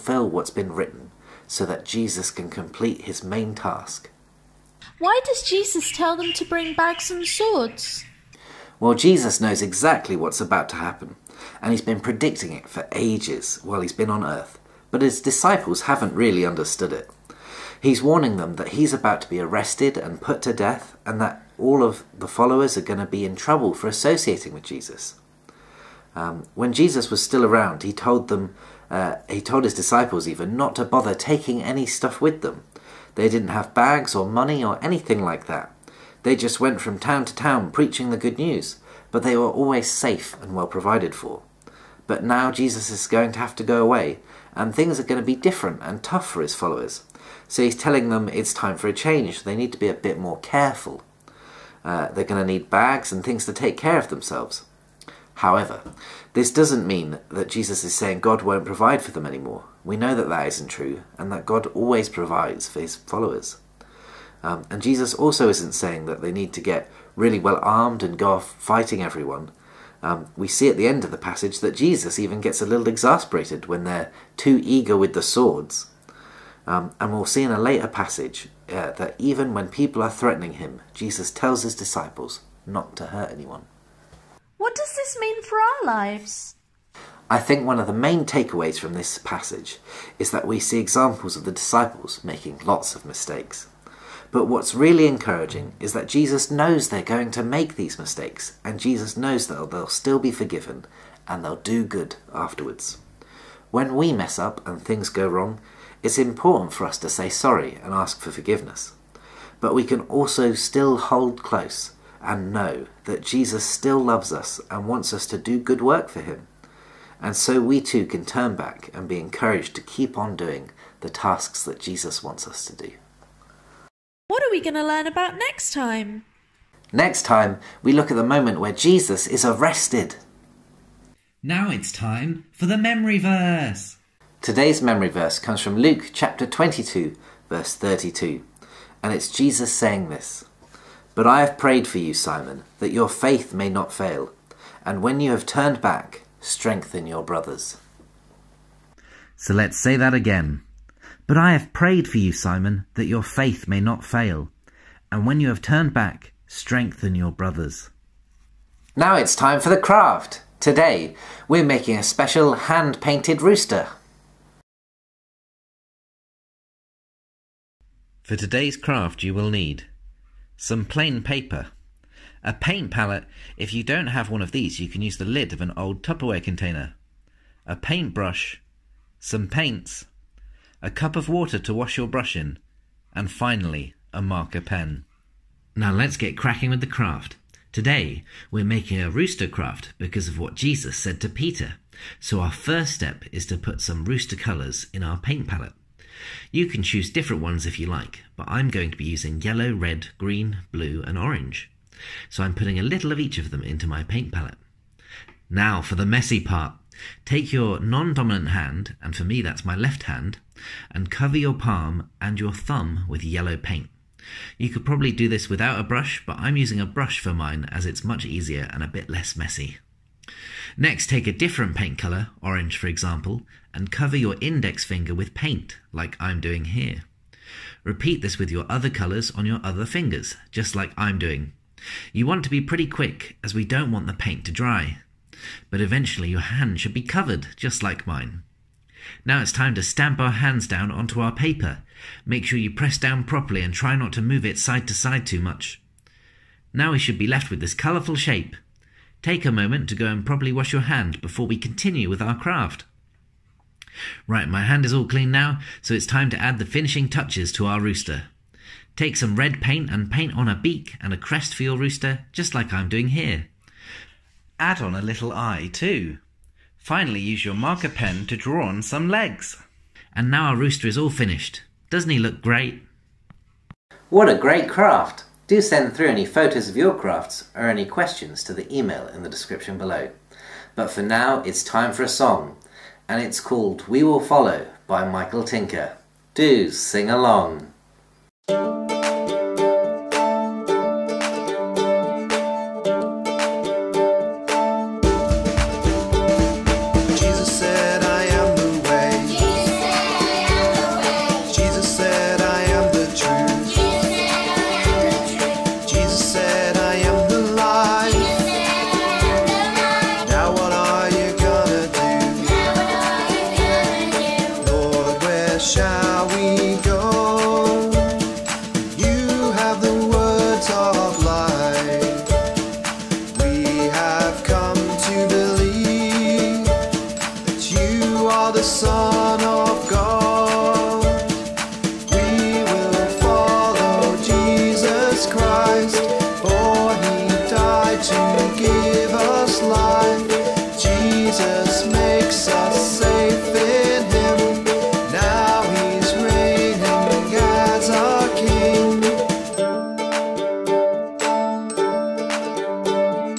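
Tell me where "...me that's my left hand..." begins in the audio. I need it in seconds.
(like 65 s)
209 s.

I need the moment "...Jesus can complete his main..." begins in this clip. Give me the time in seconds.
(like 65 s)
1 s.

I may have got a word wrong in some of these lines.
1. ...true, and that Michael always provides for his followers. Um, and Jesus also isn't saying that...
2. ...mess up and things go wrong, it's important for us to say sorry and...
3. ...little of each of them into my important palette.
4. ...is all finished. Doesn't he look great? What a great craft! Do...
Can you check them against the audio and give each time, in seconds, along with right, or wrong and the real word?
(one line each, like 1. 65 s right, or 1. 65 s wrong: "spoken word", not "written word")
1. 60 s wrong: "God", not "Michael"
2. 104 s right
3. 202 s wrong: "paint", not "important"
4. 270 s right.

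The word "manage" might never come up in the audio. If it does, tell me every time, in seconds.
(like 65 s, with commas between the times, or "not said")
not said.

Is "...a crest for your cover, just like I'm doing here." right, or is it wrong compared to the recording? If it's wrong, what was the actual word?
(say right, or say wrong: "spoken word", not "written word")
wrong: "rooster", not "cover".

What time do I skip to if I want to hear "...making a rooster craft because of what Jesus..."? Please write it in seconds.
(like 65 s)
188 s.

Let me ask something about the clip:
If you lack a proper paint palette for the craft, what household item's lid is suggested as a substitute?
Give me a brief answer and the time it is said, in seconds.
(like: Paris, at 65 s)
Tupperware container, at 176 s.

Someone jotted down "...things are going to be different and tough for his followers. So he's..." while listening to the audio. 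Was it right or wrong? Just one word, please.
right.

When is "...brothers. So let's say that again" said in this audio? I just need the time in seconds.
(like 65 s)
147 s.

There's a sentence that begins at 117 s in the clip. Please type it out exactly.
And so we too can turn back and be encouraged to keep on doing the tasks that Jesus wants us to do.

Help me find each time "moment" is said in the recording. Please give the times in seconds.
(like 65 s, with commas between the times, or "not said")
128 s, 249 s.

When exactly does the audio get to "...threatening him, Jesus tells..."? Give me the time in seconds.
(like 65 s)
80 s.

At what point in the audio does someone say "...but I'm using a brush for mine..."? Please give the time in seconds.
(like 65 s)
216 s.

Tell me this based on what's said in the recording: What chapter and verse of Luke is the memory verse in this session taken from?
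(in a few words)
Luke 22:32.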